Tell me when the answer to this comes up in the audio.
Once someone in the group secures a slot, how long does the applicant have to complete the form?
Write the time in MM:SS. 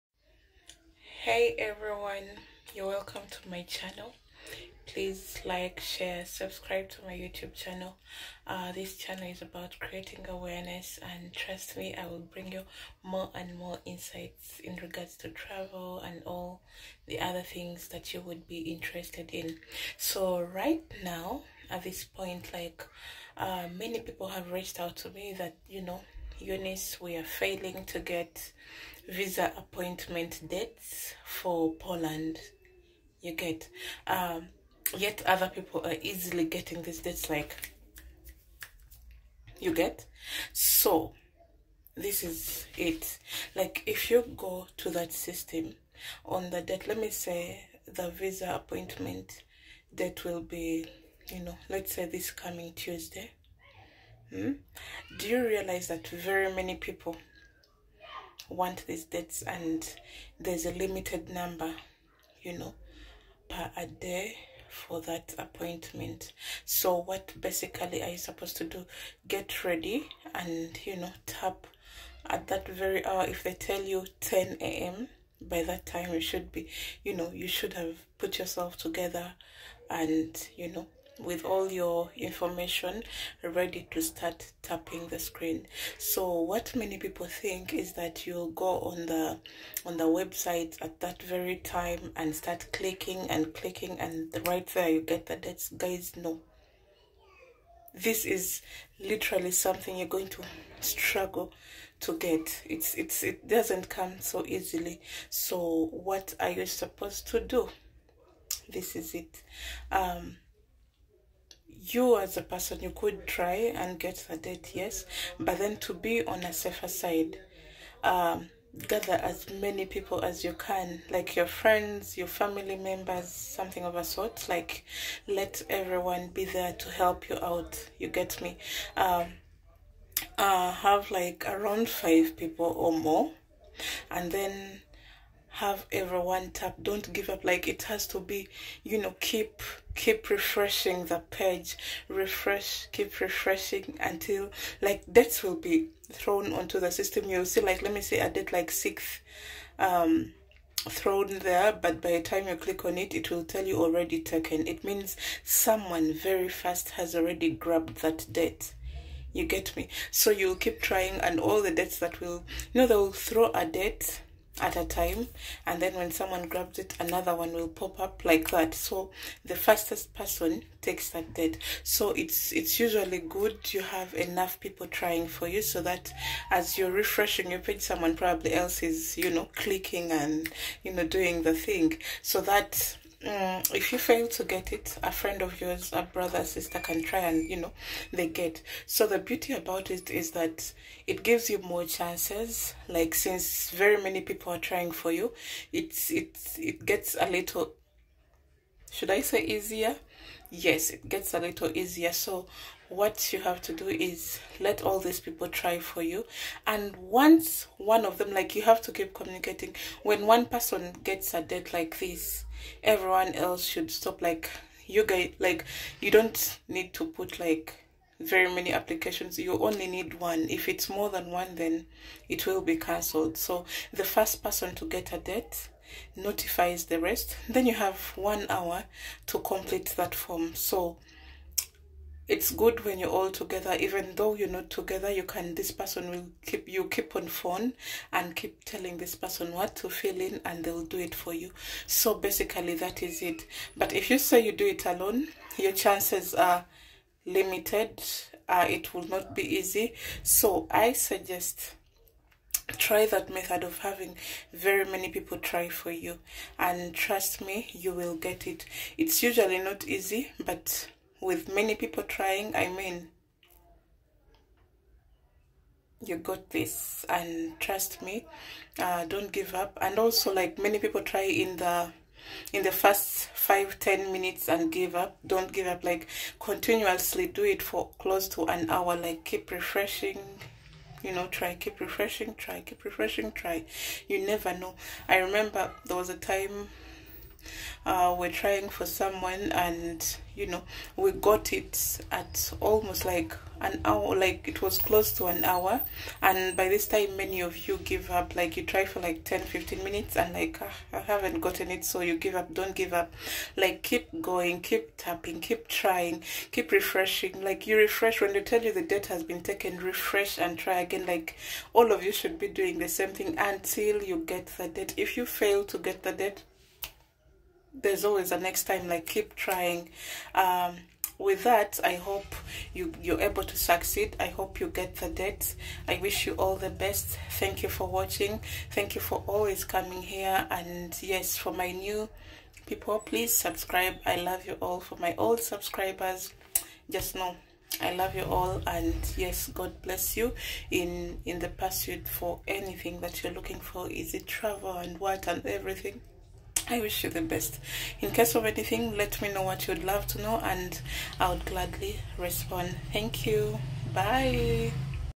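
03:48.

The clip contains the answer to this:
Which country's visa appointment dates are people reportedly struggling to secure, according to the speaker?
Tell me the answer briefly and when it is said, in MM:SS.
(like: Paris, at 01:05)
Poland, at 00:31.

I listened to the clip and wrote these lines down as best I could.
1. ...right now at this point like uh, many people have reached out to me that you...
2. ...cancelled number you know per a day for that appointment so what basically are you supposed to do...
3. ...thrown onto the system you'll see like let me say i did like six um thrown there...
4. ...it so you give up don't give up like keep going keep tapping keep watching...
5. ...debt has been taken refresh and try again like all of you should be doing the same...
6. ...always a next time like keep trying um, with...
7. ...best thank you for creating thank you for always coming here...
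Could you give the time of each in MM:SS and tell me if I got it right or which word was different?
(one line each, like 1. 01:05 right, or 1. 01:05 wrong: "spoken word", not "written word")
1. 00:20 right
2. 01:00 wrong: "limited", not "cancelled"
3. 02:26 right
4. 05:01 wrong: "trying", not "watching"
5. 05:08 right
6. 05:18 right
7. 05:26 wrong: "watching", not "creating".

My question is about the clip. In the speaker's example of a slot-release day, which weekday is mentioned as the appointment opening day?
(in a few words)
Tuesday.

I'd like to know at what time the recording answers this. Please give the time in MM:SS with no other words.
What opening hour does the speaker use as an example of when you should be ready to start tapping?
01:14.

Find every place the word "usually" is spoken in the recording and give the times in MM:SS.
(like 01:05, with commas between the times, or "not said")
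02:52, 04:19.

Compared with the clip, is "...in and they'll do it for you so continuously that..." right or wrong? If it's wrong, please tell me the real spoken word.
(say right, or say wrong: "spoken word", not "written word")
wrong: "basically", not "continuously".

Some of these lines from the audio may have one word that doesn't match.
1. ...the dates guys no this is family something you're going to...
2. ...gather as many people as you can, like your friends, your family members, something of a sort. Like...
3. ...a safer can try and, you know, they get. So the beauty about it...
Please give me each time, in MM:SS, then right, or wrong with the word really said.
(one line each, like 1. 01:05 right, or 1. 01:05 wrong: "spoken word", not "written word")
1. 01:35 wrong: "literally", not "family"
2. 01:58 right
3. 03:06 wrong: "sister", not "safer".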